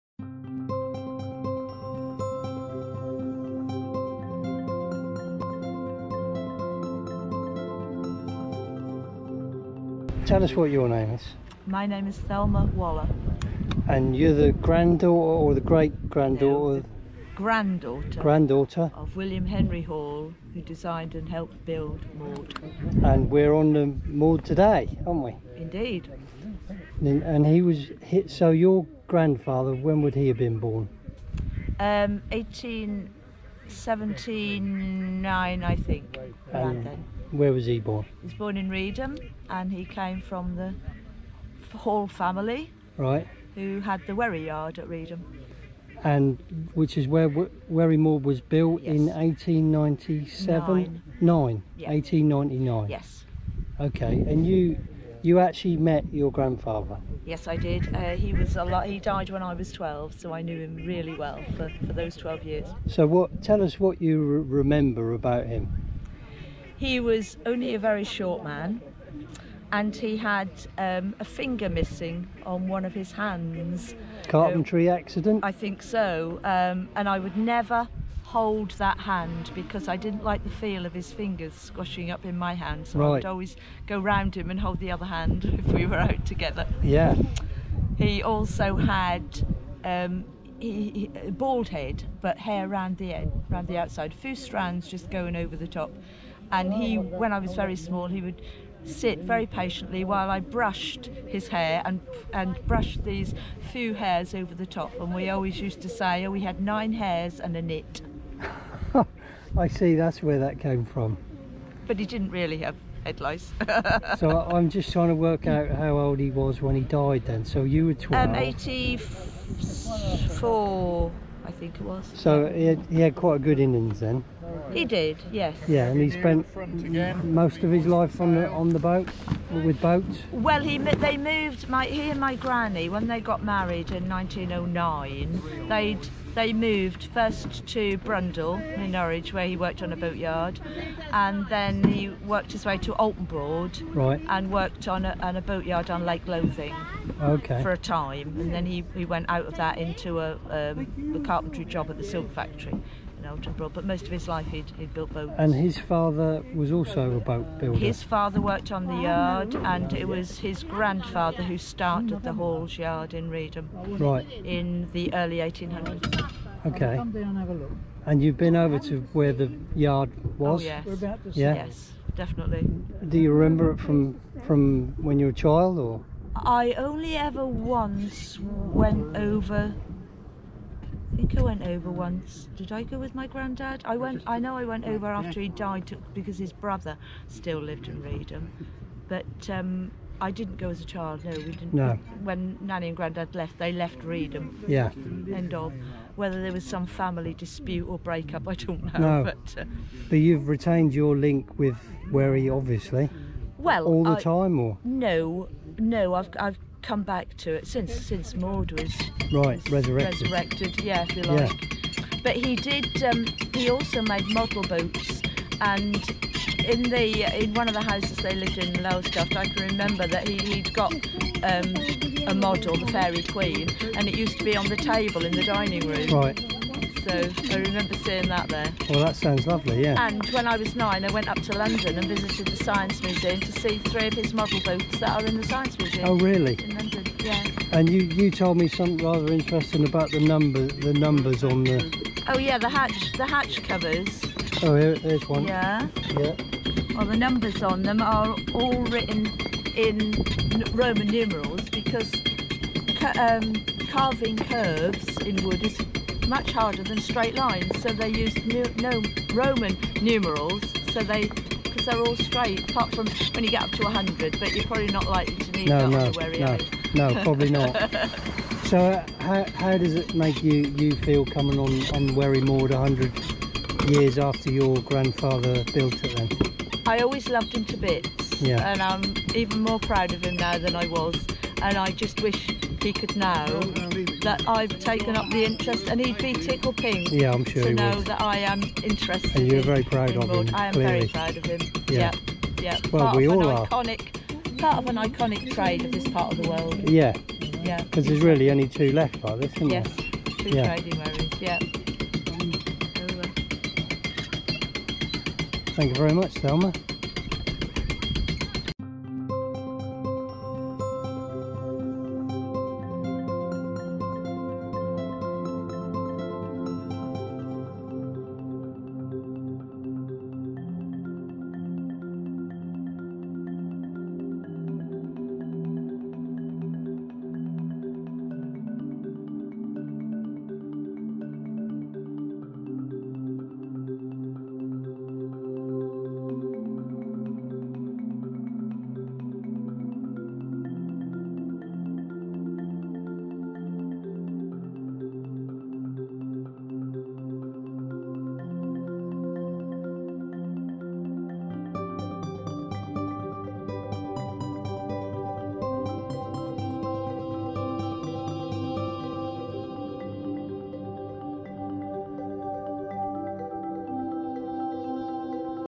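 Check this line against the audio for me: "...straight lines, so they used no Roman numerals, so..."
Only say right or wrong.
right.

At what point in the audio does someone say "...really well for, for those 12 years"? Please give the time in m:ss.
1:00.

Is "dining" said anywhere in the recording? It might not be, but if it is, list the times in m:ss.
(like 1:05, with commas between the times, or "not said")
3:45.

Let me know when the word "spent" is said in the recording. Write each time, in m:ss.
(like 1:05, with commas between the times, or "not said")
2:06.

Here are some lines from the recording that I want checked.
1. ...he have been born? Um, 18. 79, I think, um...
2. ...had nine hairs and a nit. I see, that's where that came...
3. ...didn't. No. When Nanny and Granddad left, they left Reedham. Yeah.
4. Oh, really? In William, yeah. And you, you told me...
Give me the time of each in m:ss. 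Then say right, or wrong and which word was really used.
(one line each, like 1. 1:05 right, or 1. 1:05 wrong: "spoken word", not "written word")
1. 0:30 right
2. 1:46 right
3. 3:11 right
4. 3:56 wrong: "London", not "William".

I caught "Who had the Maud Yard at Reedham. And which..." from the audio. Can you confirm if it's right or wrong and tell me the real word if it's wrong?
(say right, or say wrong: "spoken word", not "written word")
wrong: "Wherry", not "Maud".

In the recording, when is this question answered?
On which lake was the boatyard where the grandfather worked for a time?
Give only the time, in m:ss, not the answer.
2:26.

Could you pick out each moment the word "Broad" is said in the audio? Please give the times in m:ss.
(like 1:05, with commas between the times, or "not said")
2:23, 2:33.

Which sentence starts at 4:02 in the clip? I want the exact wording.
Oh yeah, the hatch, the hatch covers.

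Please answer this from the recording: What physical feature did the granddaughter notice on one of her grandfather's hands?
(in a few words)
A finger missing.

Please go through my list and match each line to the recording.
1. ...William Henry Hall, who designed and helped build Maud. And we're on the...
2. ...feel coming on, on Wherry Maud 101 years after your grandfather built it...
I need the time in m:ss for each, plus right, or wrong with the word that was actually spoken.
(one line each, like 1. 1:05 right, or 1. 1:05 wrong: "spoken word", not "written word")
1. 0:19 right
2. 4:30 wrong: "100", not "101".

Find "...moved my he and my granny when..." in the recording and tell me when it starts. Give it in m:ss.
2:11.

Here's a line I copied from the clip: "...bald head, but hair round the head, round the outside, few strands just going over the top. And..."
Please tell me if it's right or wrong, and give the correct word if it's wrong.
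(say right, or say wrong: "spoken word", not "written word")
right.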